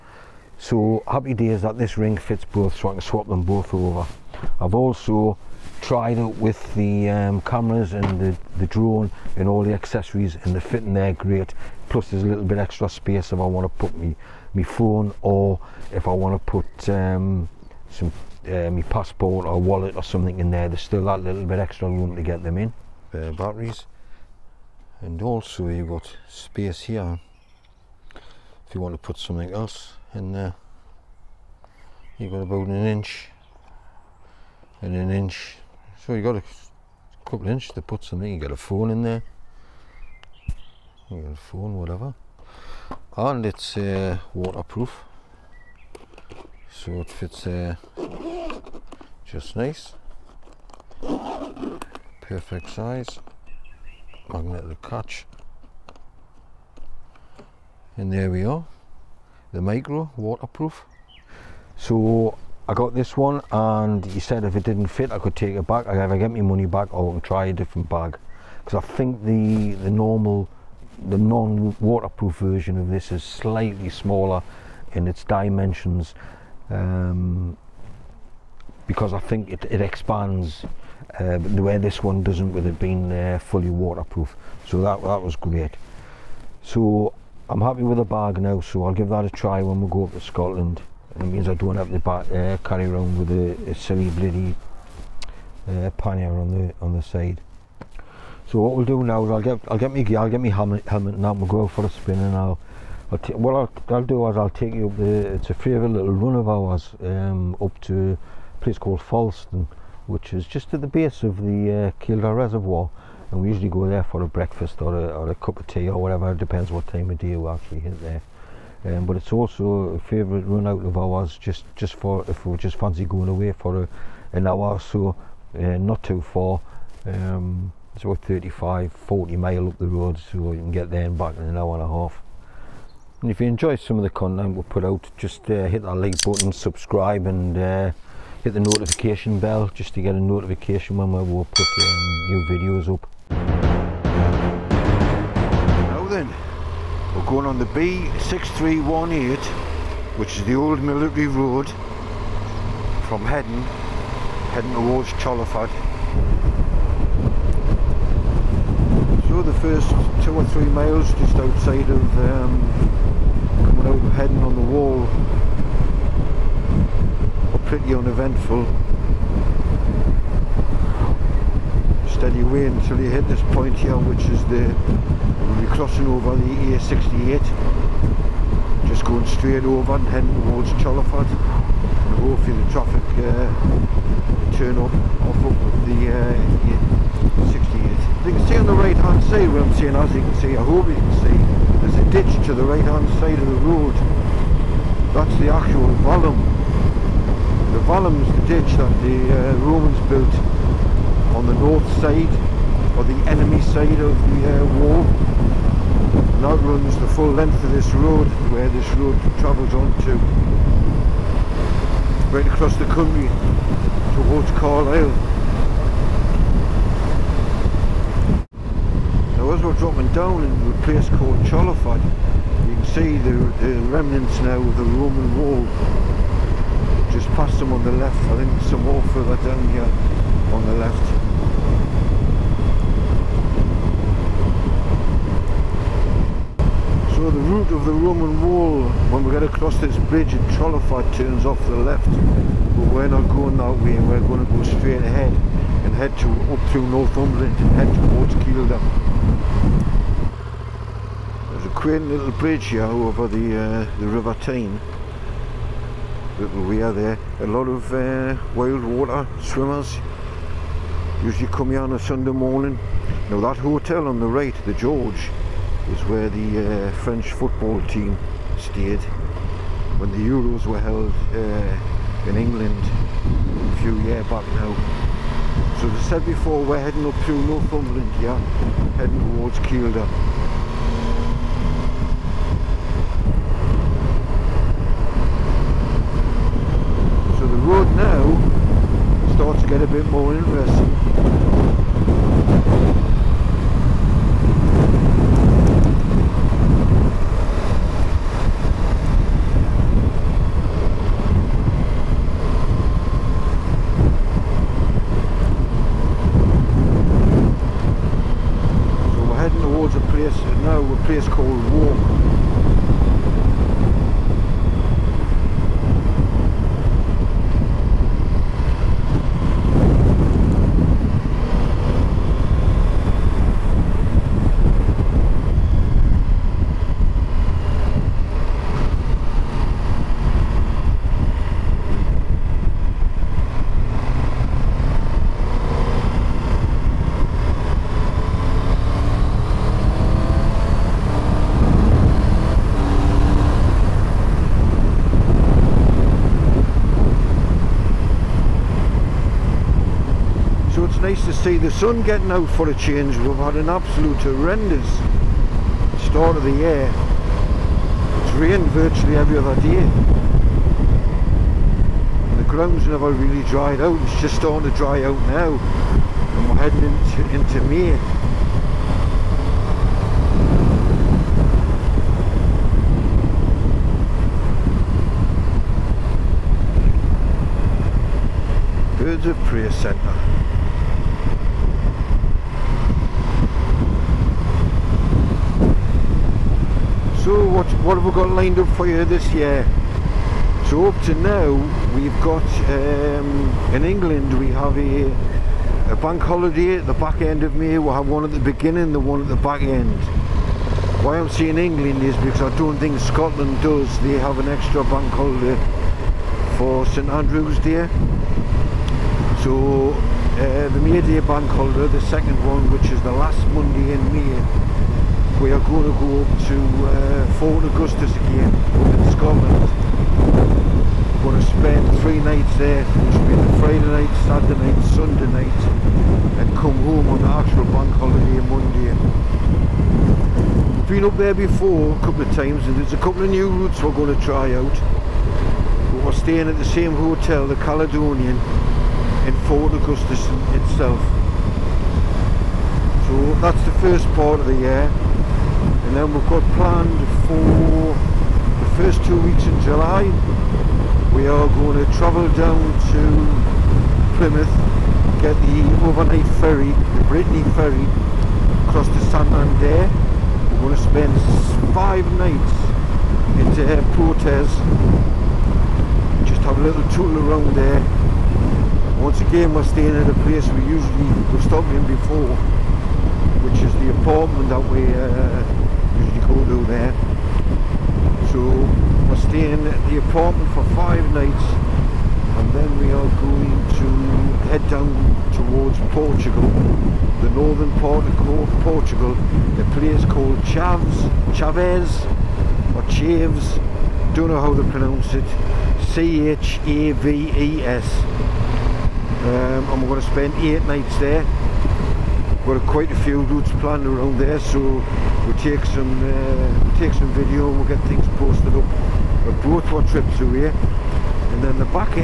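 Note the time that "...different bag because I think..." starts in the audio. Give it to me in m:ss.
1:07.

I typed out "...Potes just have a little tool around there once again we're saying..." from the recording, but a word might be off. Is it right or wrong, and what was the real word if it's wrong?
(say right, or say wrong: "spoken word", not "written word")
wrong: "staying", not "saying".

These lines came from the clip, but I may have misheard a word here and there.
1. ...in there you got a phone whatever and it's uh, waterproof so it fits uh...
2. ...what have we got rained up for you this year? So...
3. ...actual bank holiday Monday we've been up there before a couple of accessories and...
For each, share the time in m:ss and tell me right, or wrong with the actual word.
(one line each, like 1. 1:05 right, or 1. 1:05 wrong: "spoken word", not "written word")
1. 0:38 right
2. 6:27 wrong: "lined", not "rained"
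3. 7:07 wrong: "times", not "accessories".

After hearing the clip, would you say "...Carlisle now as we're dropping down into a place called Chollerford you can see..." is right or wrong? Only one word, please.
right.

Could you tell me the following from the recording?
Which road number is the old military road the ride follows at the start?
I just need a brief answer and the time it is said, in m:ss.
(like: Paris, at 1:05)
B6318, at 2:27.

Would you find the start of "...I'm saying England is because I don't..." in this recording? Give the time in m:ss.
6:41.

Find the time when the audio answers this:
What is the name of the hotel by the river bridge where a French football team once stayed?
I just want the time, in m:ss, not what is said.
4:24.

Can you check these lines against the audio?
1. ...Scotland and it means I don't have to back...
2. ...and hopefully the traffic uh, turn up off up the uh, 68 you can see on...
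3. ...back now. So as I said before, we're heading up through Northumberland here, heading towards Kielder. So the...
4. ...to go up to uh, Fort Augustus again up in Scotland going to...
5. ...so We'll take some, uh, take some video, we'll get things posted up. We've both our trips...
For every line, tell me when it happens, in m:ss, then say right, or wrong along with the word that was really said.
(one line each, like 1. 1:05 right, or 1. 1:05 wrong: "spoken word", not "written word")
1. 1:30 right
2. 3:01 right
3. 4:34 right
4. 6:55 right
5. 8:24 right.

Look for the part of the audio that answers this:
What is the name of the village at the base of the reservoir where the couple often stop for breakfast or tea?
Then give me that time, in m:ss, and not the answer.
1:49.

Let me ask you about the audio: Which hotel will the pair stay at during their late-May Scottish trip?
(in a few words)
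The Caledonian.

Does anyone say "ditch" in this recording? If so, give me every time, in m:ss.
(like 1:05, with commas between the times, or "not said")
3:12, 3:18.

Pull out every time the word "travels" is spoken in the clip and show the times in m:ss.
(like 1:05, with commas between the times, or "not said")
3:29, 7:31.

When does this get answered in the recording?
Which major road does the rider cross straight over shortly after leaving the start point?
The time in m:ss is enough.
2:56.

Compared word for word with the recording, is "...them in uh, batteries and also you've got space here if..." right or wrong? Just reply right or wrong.
right.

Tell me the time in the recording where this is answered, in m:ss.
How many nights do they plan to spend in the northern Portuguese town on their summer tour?
8:20.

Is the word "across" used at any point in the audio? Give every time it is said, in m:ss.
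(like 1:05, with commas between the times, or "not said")
3:32, 3:59, 7:38.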